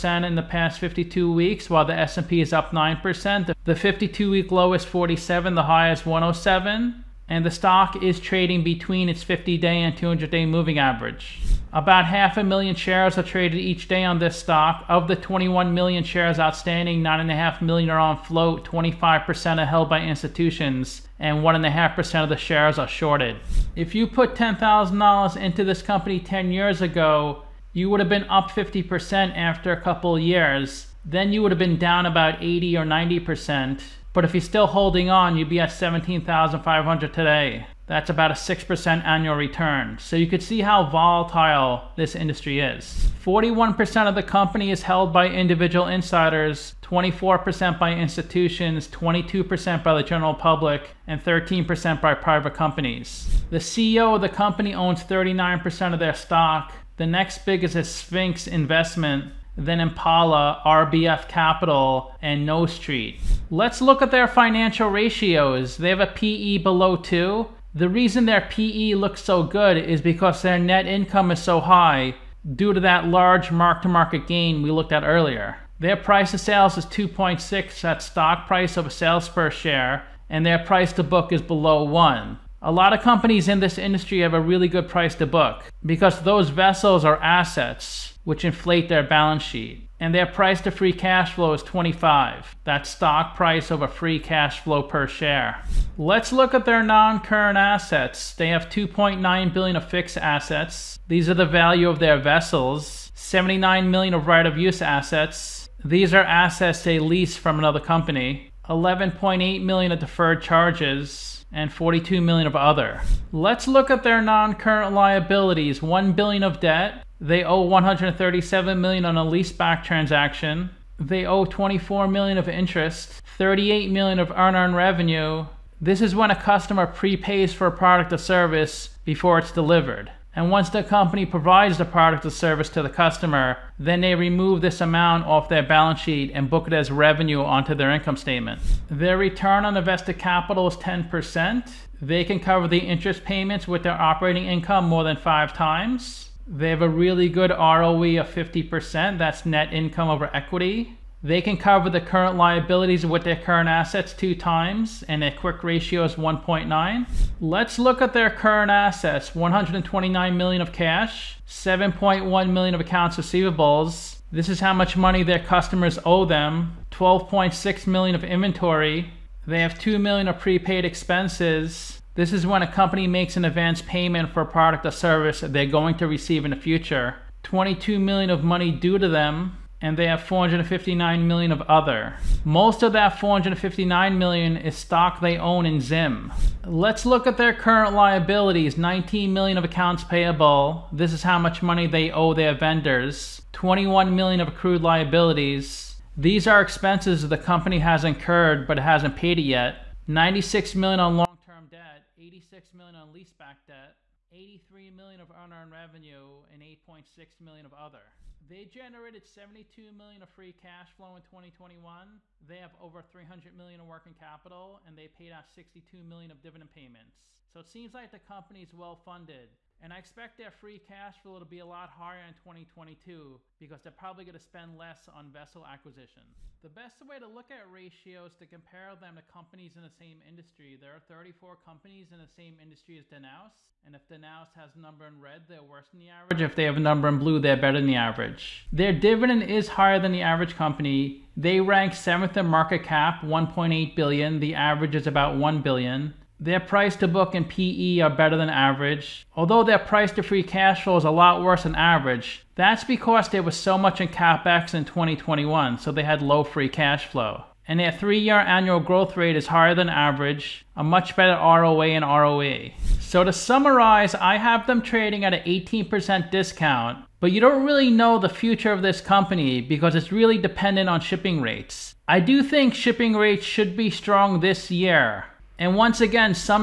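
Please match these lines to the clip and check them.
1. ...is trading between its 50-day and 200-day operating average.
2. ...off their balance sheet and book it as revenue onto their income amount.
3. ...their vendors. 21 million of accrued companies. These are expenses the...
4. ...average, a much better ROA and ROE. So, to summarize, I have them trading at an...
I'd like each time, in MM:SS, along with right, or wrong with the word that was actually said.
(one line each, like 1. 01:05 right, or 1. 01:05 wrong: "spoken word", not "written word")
1. 00:08 wrong: "moving", not "operating"
2. 02:15 wrong: "statement", not "amount"
3. 03:12 wrong: "liabilities", not "companies"
4. 04:19 right.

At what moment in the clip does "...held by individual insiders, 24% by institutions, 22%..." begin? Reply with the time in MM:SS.
00:44.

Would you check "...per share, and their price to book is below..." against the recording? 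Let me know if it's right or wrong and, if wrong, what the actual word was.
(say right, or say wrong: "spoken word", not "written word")
right.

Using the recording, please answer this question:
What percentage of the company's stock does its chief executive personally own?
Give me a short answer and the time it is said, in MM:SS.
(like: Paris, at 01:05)
39%, at 00:55.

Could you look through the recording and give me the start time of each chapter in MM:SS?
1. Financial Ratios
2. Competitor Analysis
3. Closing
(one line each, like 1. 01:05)
1. 01:02
2. 03:45
3. 04:21.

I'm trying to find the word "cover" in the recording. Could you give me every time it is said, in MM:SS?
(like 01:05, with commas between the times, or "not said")
02:22, 02:31.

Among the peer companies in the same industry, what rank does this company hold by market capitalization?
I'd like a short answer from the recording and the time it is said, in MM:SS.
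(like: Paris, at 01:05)
7th, at 04:01.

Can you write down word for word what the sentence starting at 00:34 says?
But if you're still holding on, you'd be at 17,500 today.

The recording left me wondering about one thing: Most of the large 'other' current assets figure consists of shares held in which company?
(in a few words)
Zim.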